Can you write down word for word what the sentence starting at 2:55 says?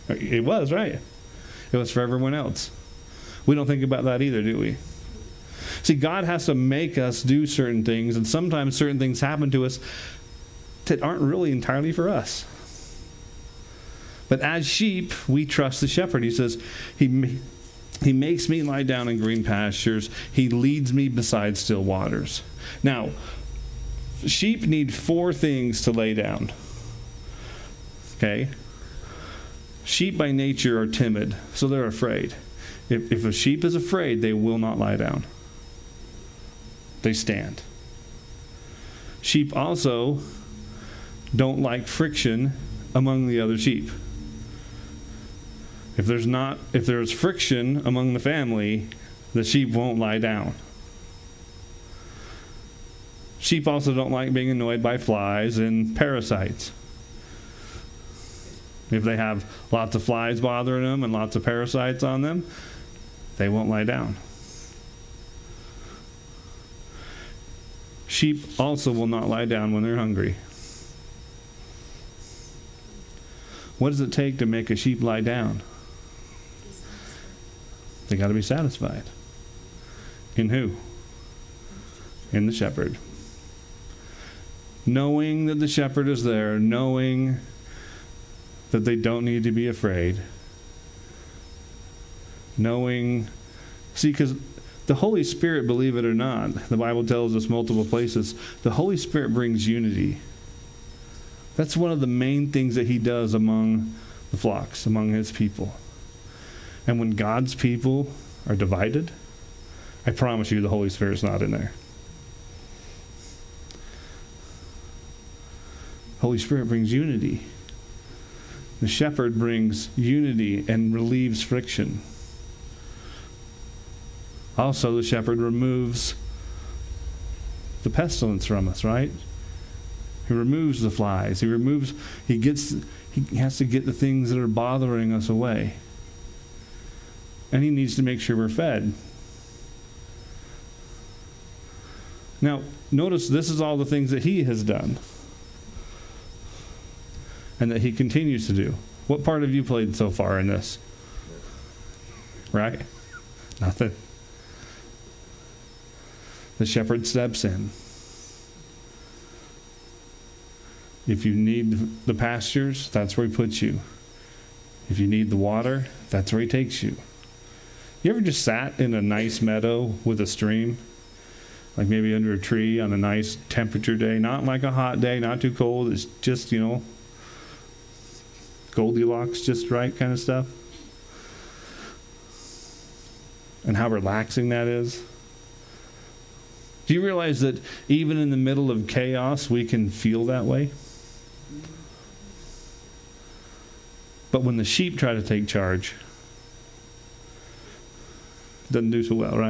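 It's just, you know, Goldilocks, just right kind of stuff.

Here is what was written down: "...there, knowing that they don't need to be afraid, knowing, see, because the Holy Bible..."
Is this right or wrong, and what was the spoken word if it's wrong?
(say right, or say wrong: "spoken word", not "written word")
wrong: "Spirit", not "Bible".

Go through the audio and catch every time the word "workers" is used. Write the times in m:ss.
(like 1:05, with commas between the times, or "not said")
not said.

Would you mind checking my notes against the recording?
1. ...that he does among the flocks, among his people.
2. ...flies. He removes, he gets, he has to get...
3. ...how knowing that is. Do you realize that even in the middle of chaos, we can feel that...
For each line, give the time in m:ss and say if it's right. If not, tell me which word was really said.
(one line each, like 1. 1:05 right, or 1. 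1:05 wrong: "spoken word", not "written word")
1. 1:42 right
2. 2:10 right
3. 3:03 wrong: "relaxing", not "knowing".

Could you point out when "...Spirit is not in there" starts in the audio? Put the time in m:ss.
1:50.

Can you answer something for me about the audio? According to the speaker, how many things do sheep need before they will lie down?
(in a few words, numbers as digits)
4.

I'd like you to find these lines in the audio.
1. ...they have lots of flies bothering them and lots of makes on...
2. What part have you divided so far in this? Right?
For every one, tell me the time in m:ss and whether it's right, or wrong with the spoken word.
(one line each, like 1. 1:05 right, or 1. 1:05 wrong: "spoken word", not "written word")
1. 0:59 wrong: "parasites", not "makes"
2. 2:29 wrong: "played", not "divided".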